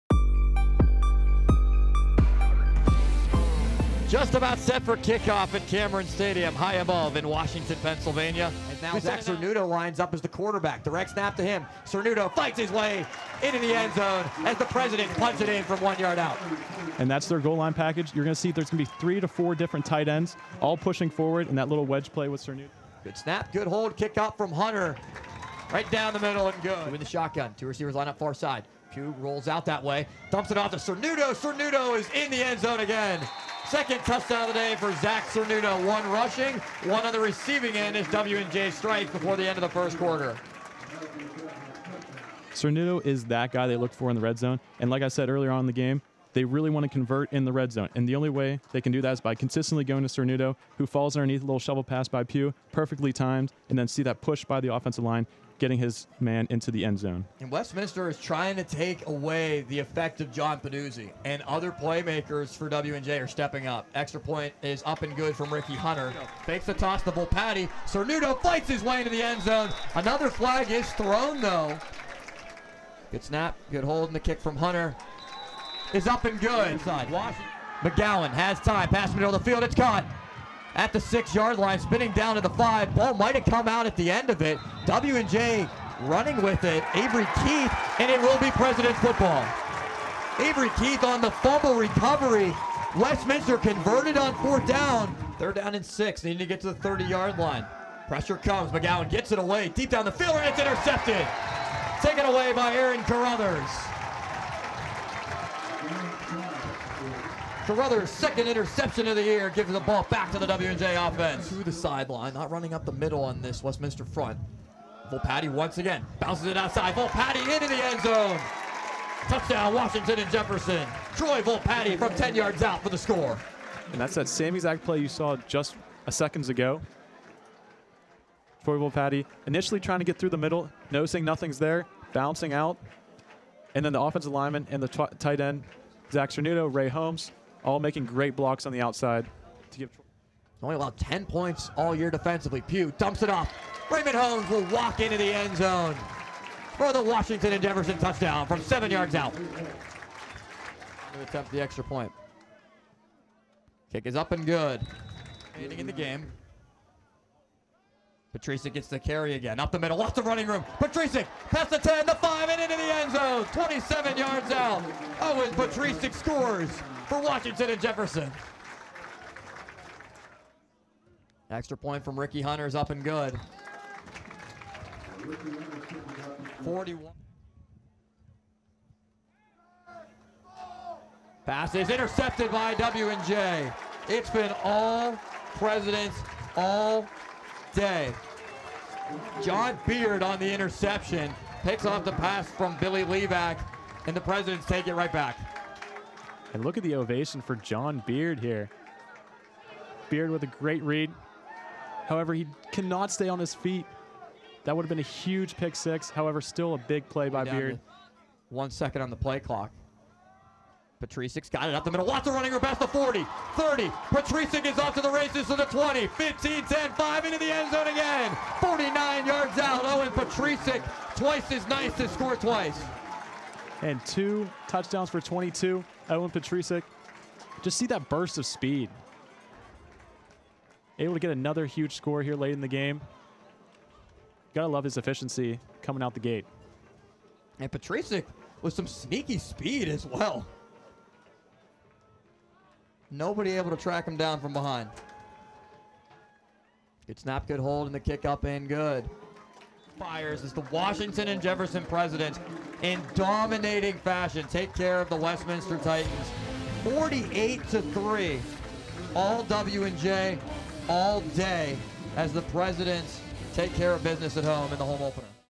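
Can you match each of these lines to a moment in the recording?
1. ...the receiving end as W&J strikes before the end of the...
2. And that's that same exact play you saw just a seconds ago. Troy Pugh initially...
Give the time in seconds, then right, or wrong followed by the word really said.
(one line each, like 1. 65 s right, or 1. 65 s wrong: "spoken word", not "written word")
1. 37 s right
2. 123 s wrong: "Volpatti", not "Pugh".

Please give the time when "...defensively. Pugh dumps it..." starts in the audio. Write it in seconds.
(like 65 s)
142 s.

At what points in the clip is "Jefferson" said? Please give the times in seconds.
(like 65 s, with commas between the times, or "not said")
120 s, 147 s, 167 s, 251 s.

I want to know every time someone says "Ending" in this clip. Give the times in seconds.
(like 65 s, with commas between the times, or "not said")
155 s.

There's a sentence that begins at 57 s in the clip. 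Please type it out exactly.
And Westminster is trying to take away the effect of John Peduzzi, and other playmakers for W&J are stepping up.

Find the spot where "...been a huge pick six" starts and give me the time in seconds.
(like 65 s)
204 s.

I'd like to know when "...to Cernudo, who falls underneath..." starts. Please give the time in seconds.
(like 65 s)
50 s.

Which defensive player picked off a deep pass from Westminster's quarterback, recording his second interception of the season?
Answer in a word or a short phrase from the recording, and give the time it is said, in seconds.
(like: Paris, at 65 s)
Aaron Carruthers, at 102 s.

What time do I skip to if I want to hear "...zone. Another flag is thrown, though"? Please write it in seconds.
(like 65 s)
69 s.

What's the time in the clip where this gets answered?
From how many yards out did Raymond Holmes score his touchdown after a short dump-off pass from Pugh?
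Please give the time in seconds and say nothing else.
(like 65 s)
148 s.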